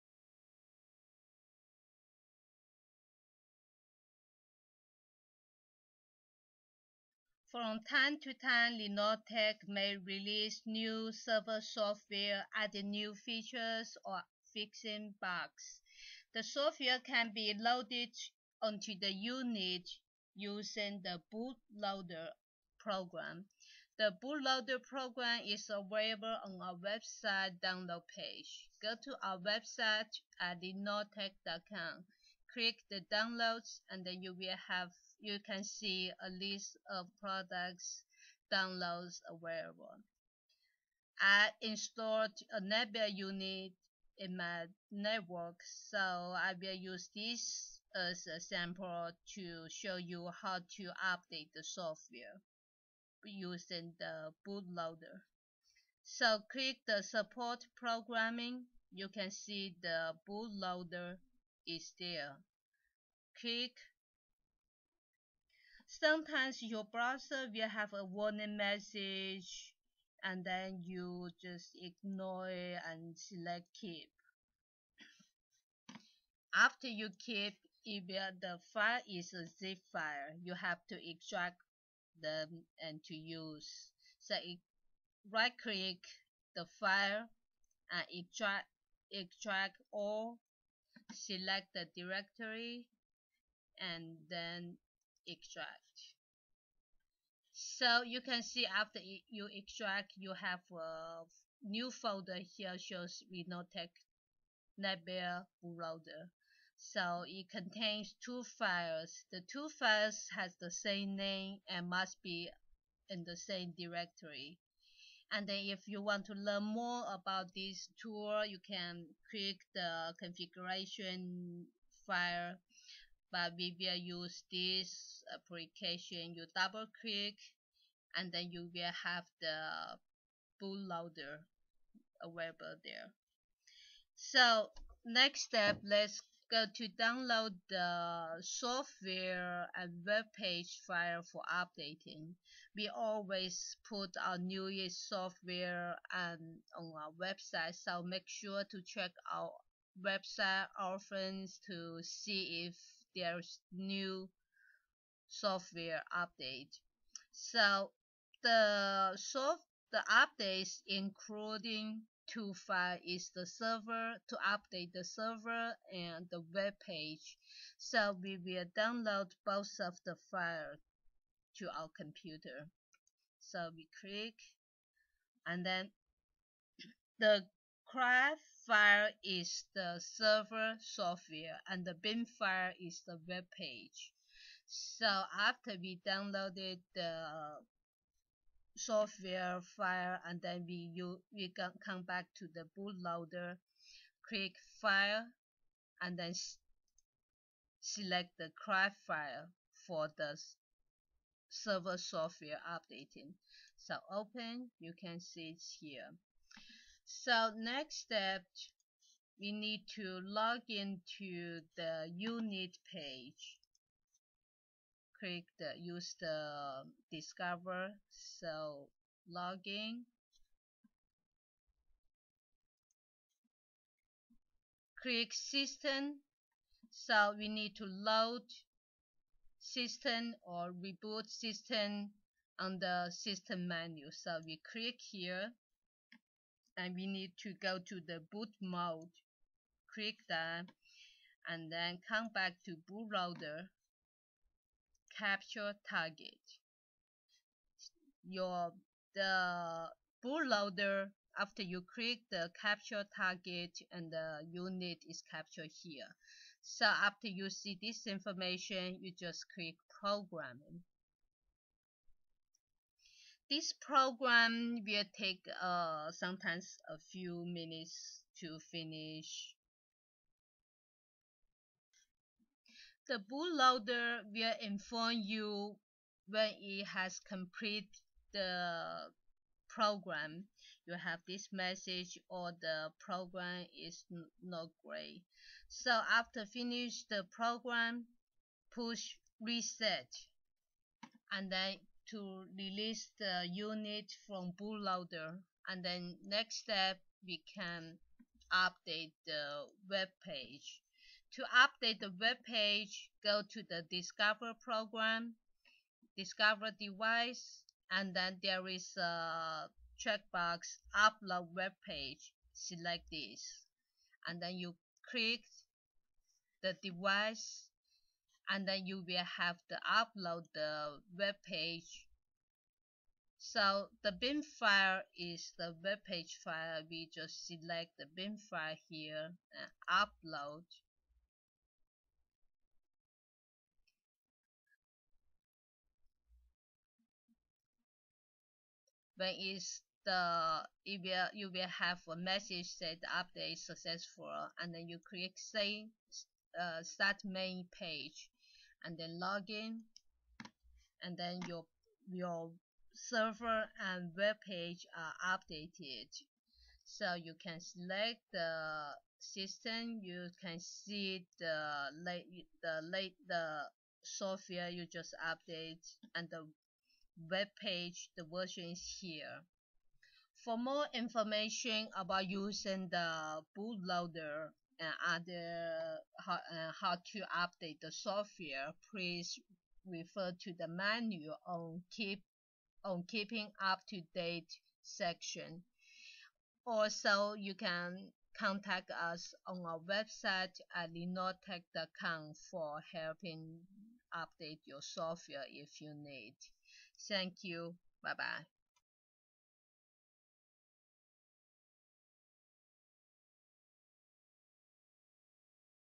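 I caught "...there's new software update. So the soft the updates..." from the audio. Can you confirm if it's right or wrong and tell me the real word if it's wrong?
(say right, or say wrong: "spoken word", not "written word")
right.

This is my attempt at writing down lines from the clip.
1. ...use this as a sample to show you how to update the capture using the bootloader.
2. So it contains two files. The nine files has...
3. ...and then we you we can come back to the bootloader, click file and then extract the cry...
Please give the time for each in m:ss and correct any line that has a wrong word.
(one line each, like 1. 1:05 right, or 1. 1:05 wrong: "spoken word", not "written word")
1. 0:46 wrong: "software", not "capture"
2. 1:46 wrong: "two", not "nine"
3. 3:10 wrong: "select", not "extract".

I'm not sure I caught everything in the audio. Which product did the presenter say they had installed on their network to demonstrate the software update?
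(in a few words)
Nebula.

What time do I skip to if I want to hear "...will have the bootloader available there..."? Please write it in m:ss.
2:08.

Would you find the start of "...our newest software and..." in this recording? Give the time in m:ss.
2:24.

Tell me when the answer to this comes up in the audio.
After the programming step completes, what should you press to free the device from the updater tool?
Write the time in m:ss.
4:49.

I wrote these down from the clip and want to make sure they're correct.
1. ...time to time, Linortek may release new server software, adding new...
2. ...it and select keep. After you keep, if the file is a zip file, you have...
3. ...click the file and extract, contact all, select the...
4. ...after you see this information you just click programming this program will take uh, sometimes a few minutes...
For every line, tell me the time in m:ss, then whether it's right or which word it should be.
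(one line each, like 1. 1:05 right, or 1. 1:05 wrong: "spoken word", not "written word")
1. 0:07 right
2. 1:12 right
3. 1:25 wrong: "extract", not "contact"
4. 4:16 right.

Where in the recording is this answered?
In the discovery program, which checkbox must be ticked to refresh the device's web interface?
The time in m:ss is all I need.
5:10.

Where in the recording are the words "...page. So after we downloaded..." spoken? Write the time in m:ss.
3:03.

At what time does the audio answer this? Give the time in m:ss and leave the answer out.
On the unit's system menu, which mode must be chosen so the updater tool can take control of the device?
3:58.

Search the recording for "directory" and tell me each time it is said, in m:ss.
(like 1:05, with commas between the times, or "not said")
1:31, 1:53.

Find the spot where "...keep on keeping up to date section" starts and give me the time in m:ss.
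6:21.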